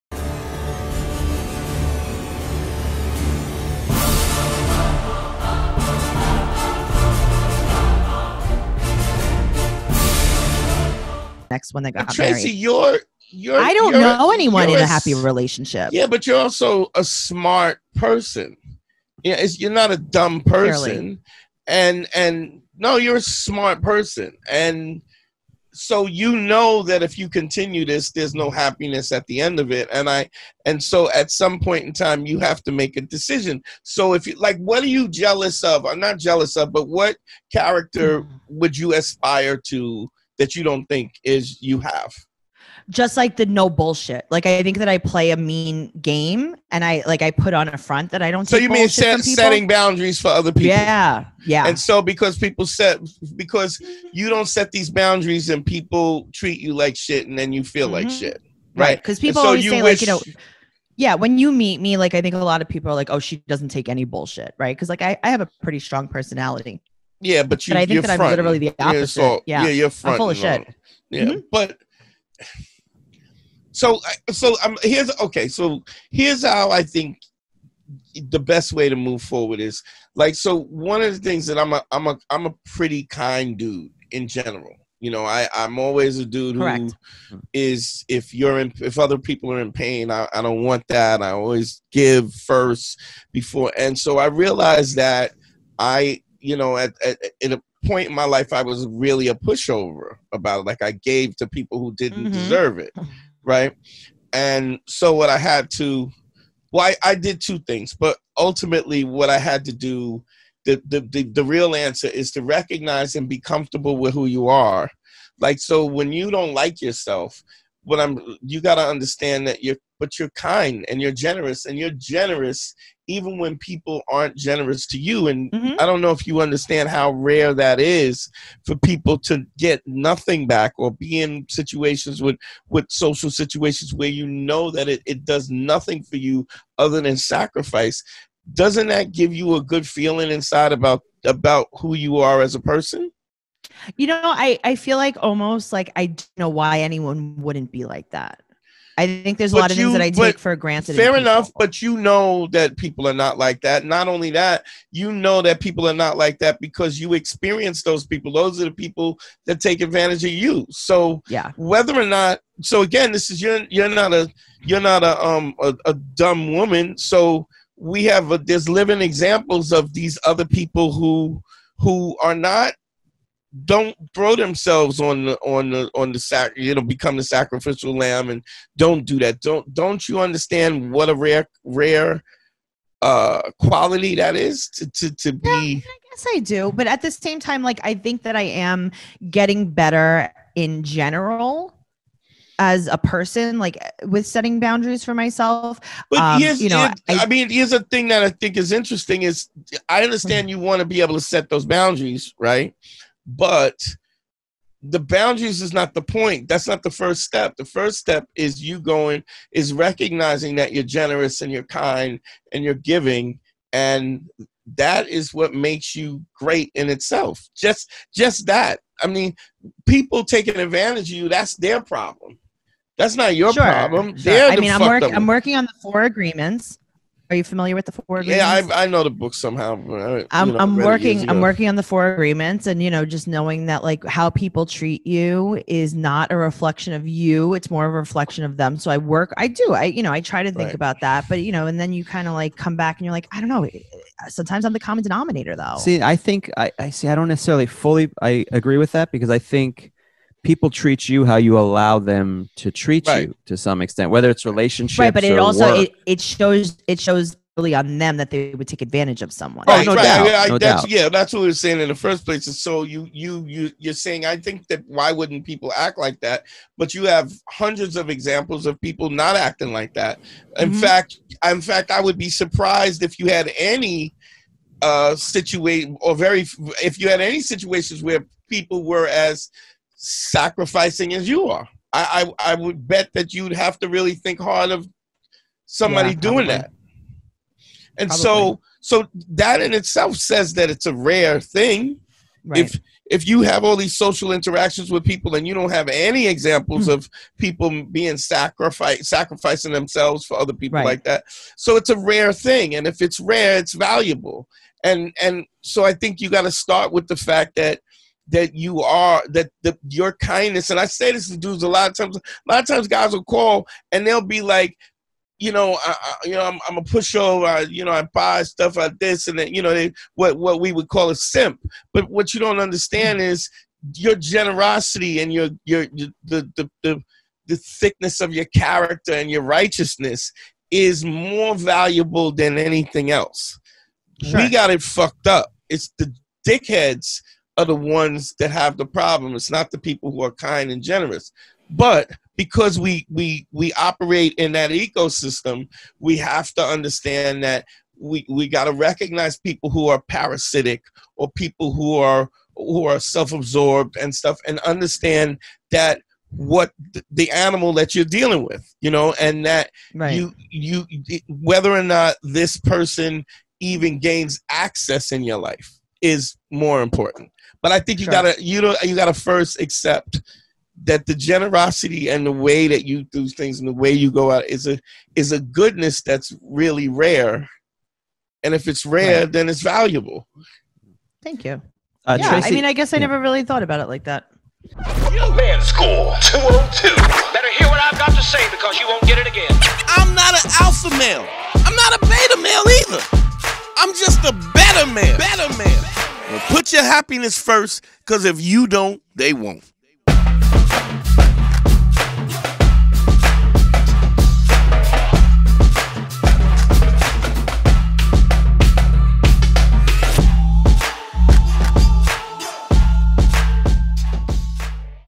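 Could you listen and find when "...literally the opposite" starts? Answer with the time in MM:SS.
01:08.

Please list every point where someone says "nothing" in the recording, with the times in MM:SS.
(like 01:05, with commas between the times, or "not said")
02:09, 02:15.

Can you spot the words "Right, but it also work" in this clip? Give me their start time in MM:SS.
04:14.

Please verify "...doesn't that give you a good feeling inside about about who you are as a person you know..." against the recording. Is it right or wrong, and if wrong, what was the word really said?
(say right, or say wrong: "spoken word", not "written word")
right.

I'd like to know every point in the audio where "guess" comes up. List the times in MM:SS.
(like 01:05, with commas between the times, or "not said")
03:06, 06:22.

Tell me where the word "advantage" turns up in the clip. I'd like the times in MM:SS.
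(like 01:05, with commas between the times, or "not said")
02:39, 03:40, 04:18.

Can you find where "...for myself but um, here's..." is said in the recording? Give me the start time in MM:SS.
03:15.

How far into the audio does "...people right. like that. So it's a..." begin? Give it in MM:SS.
05:00.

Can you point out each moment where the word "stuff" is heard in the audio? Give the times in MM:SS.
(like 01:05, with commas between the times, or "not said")
05:18, 05:54.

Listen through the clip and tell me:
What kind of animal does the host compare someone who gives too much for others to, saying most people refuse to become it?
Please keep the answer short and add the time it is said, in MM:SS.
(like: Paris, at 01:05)
lamb, at 02:57.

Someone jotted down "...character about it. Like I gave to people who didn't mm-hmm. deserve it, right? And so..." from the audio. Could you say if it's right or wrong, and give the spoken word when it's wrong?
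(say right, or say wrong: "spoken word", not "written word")
wrong: "pushover", not "character".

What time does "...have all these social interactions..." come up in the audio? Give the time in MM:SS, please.
04:53.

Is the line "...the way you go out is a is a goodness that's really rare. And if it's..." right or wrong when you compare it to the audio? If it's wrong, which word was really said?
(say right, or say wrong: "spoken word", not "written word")
right.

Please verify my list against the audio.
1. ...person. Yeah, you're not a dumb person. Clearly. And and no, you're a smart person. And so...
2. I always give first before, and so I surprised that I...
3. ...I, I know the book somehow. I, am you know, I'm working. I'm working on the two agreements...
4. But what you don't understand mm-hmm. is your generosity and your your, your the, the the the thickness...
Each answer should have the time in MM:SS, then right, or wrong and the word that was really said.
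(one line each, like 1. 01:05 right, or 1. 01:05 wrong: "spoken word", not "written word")
1. 00:17 right
2. 01:31 wrong: "realized", not "surprised"
3. 03:48 wrong: "four", not "two"
4. 05:21 right.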